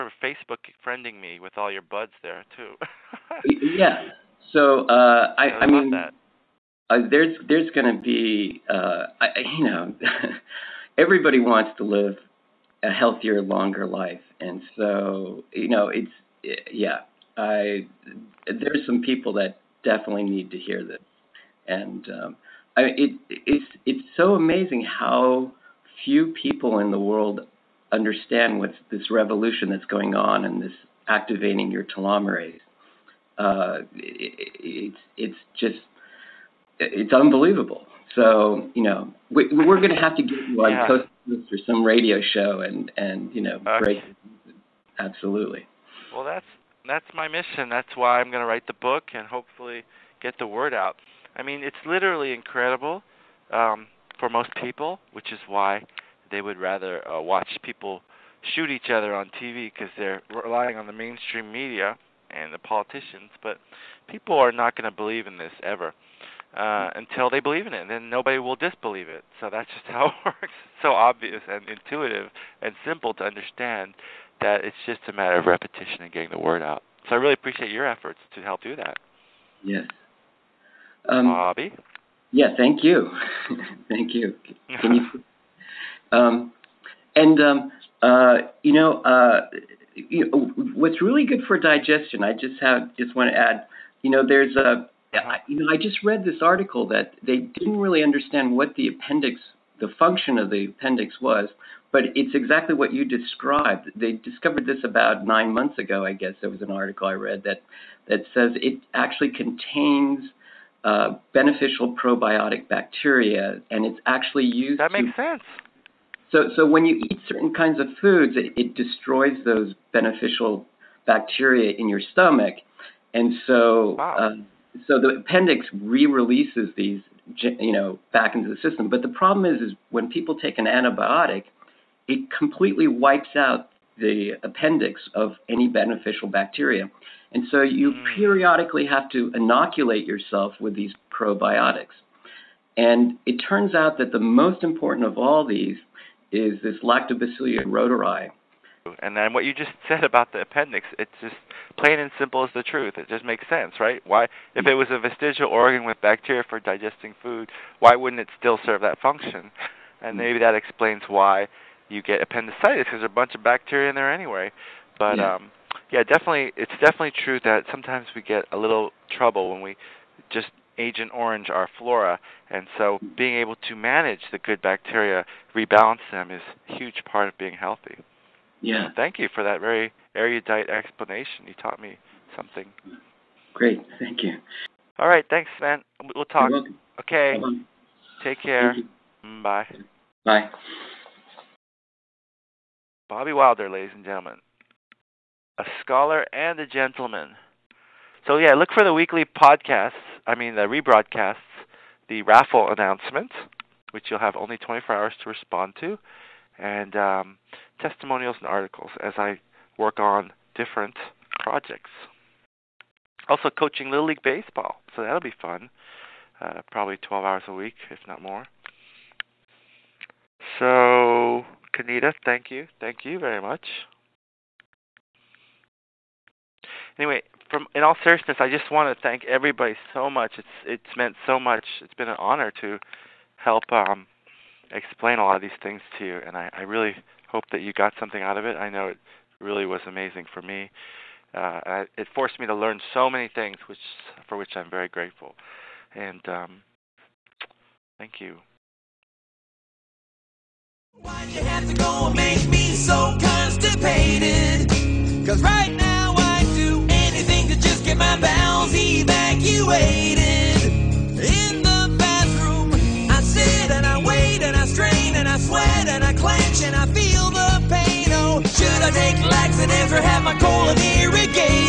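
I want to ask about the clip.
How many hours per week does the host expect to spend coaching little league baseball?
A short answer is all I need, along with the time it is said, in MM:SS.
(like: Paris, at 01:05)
12, at 03:36.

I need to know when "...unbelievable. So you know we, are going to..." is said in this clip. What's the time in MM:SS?
00:37.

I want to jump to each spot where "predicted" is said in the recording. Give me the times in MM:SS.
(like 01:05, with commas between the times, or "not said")
not said.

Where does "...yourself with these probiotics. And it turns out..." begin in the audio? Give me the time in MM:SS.
02:20.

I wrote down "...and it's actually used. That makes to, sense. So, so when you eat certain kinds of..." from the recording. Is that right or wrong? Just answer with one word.
right.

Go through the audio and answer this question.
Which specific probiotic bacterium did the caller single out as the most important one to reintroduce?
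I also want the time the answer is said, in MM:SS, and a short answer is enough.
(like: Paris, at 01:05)
Lactobacillus reuteri, at 02:26.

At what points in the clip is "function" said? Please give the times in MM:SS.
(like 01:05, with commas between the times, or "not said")
01:39, 02:38.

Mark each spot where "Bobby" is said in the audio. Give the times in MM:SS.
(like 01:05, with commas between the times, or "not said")
01:21, 03:13.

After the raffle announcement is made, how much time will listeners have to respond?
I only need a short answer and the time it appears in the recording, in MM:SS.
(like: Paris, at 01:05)
24 hours, at 03:24.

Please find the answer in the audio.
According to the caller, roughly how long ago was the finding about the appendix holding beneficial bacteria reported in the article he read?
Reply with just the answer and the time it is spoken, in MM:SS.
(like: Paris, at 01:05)
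9 months, at 01:45.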